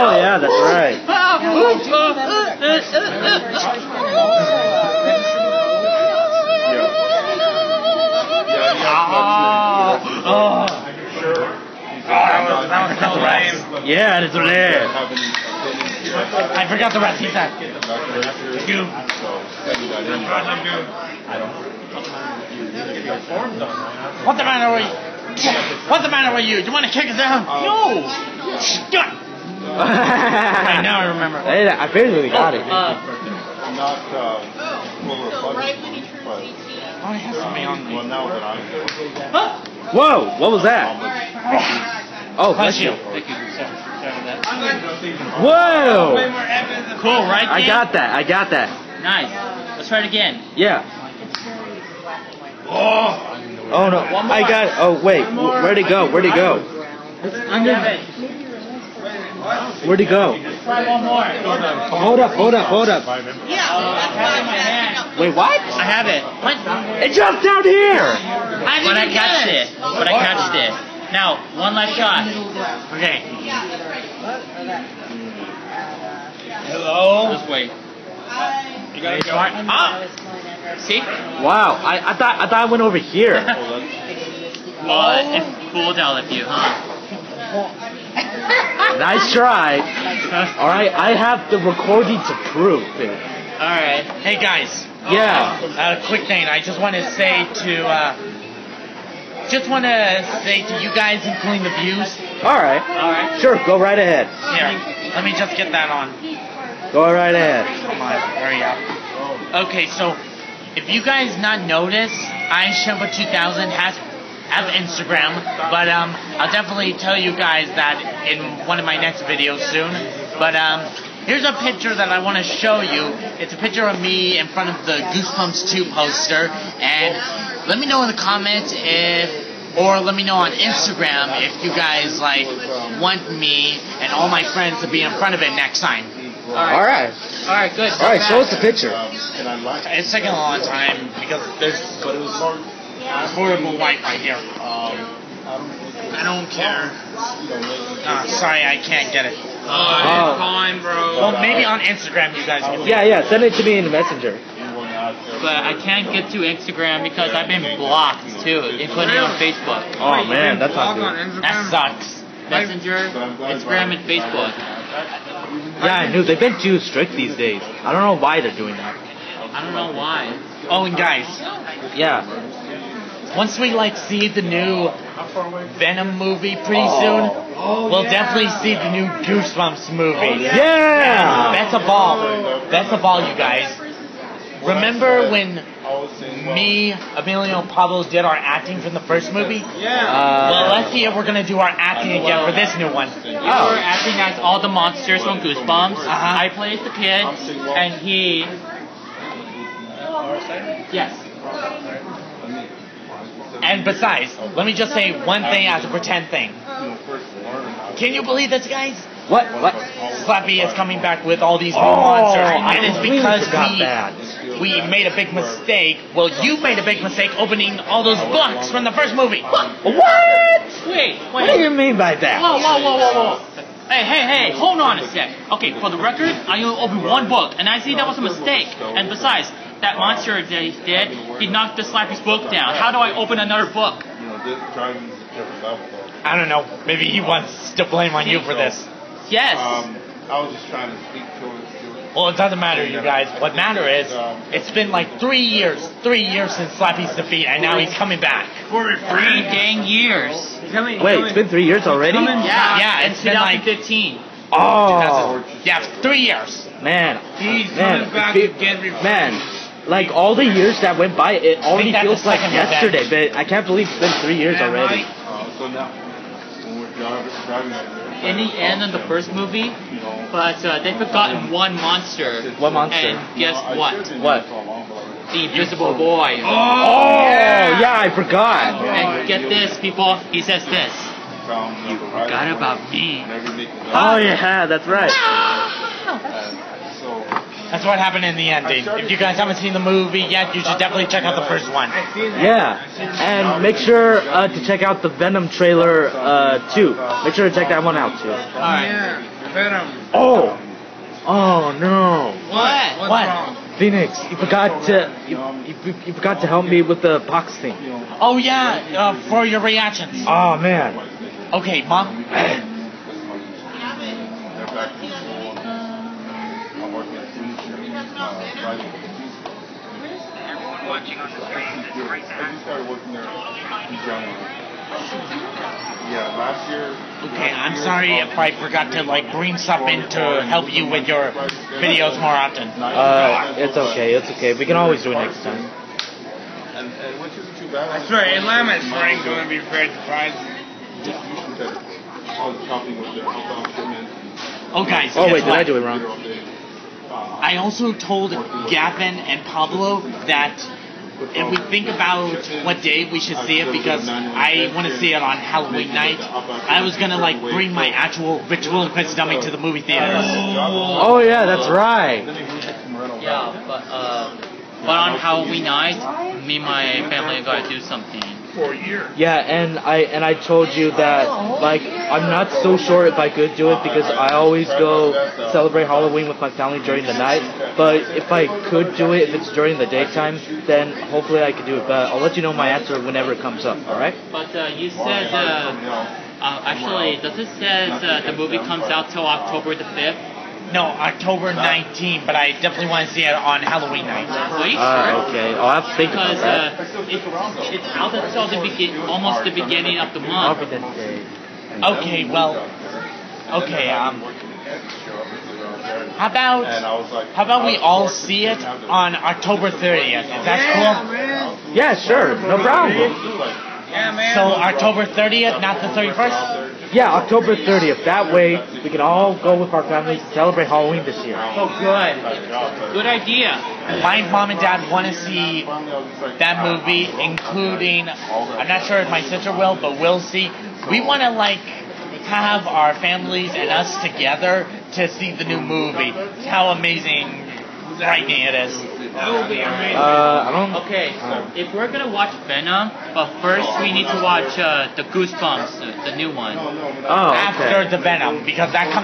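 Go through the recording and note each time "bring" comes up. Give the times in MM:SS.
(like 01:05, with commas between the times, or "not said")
05:29, 05:57.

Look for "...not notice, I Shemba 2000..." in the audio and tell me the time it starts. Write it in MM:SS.
01:51.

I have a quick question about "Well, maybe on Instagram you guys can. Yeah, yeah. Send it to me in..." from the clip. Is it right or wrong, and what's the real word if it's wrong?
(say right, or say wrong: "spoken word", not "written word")
right.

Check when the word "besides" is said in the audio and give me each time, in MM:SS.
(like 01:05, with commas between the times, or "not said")
03:23, 03:49.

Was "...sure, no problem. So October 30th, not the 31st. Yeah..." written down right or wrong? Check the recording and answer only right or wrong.
right.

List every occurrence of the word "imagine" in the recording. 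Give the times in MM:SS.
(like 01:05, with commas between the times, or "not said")
not said.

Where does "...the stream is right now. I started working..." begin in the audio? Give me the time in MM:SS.
05:21.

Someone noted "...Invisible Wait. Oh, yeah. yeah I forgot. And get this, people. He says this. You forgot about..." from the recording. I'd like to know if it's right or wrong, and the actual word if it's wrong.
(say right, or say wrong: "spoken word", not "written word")
wrong: "Boy", not "Wait".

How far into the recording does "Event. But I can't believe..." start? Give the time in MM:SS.
04:23.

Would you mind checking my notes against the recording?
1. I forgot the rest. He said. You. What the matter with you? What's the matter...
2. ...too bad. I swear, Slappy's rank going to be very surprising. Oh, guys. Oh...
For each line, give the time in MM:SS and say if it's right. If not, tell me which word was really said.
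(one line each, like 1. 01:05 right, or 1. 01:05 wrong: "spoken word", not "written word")
1. 00:16 right
2. 05:37 wrong: "Atlanta", not "Slappy".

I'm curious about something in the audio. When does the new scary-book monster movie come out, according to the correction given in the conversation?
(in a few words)
October 19th.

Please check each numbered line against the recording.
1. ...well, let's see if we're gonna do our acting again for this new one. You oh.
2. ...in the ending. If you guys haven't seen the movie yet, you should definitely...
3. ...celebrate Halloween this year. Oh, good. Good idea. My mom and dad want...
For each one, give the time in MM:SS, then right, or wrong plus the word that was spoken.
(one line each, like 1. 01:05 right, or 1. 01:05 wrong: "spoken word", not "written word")
1. 03:10 right
2. 04:48 right
3. 07:00 right.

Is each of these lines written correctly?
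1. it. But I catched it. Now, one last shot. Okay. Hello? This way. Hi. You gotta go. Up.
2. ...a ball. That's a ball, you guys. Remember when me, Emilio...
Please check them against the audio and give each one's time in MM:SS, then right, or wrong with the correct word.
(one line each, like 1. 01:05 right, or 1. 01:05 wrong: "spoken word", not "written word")
1. 01:09 right
2. 03:01 right.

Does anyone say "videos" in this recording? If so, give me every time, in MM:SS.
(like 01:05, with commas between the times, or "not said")
01:59, 05:31.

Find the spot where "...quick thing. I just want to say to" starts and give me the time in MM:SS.
01:36.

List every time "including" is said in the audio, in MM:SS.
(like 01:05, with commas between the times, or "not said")
01:41, 02:38, 07:07.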